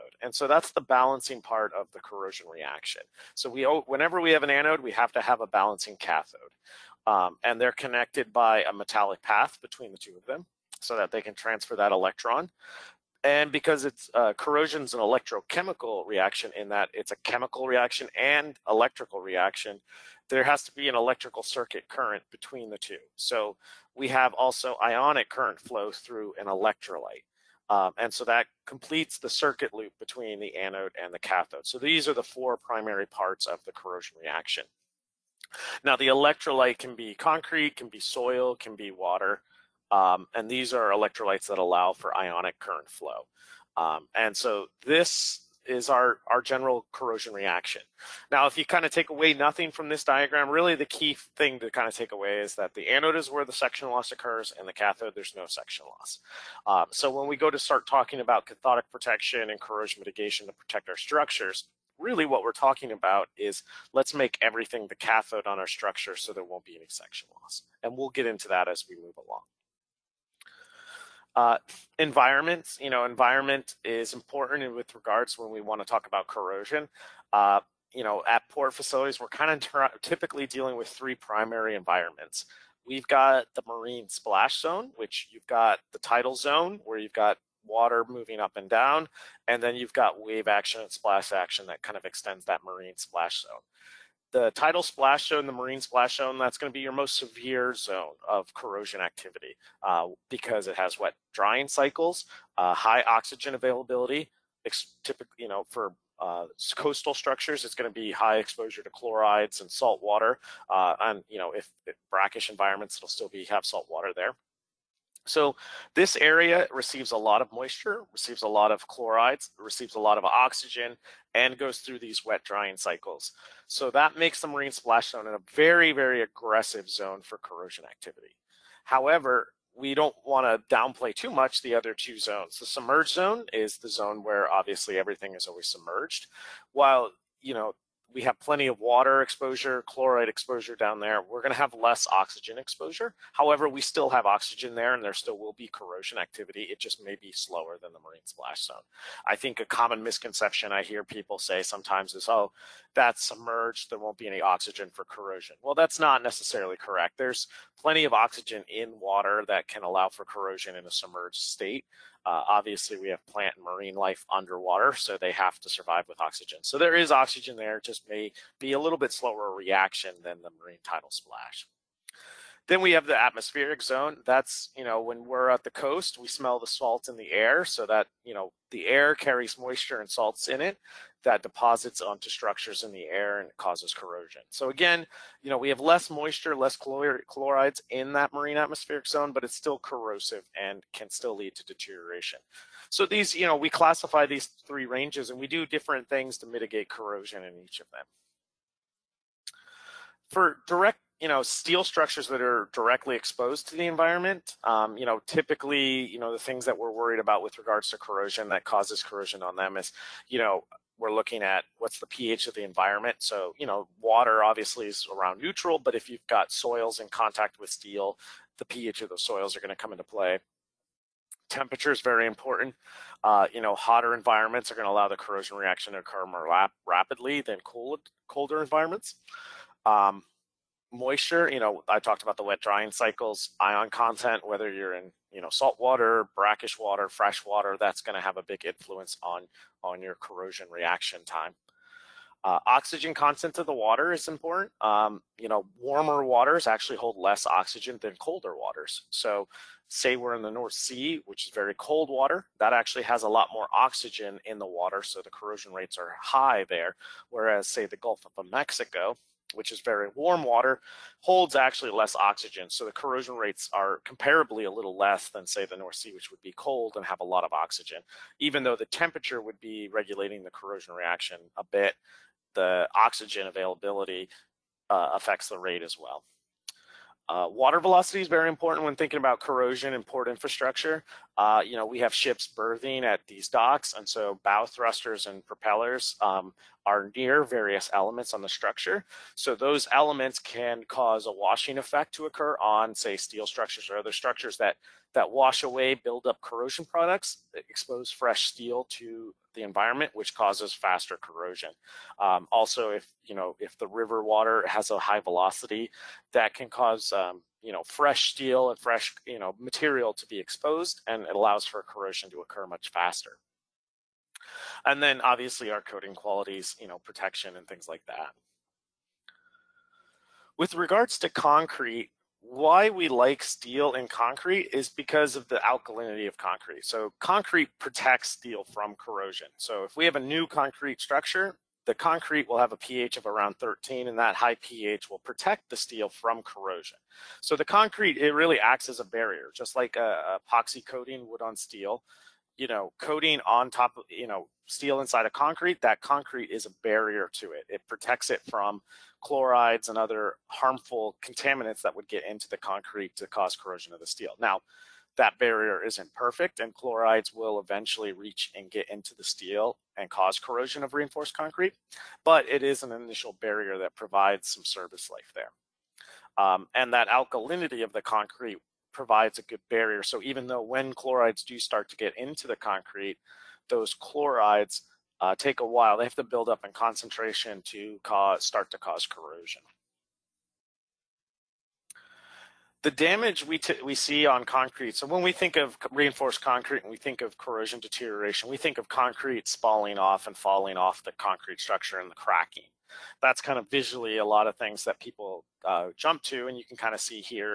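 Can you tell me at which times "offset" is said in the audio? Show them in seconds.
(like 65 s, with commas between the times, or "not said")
not said.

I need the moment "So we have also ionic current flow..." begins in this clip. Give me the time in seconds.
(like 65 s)
23 s.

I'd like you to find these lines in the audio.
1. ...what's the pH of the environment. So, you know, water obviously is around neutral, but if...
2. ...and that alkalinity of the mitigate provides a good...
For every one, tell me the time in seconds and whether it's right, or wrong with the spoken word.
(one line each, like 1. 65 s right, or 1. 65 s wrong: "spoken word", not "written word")
1. 211 s right
2. 366 s wrong: "concrete", not "mitigate".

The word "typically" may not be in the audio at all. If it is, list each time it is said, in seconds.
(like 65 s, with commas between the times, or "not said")
80 s, 105 s, 205 s.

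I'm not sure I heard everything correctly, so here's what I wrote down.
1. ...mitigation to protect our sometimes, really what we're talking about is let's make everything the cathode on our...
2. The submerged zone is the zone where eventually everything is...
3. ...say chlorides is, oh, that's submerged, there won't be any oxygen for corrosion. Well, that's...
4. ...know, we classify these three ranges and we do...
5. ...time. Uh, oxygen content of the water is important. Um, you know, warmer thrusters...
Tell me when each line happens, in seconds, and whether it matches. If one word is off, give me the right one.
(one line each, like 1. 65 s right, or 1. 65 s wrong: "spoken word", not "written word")
1. 60 s wrong: "structures", not "sometimes"
2. 132 s wrong: "obviously", not "eventually"
3. 151 s wrong: "sometimes", not "chlorides"
4. 193 s right
5. 241 s wrong: "waters", not "thrusters".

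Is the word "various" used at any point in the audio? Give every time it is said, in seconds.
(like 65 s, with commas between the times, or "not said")
287 s.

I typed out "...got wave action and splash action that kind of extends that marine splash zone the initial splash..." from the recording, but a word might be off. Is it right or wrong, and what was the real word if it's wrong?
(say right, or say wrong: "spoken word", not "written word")
wrong: "tidal", not "initial".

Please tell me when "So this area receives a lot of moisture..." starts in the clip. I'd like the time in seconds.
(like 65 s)
115 s.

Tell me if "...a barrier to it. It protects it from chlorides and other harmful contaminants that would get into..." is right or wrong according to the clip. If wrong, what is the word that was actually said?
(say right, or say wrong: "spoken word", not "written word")
right.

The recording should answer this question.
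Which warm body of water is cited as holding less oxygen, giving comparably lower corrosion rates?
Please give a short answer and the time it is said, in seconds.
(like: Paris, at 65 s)
Gulf of Mexico, at 257 s.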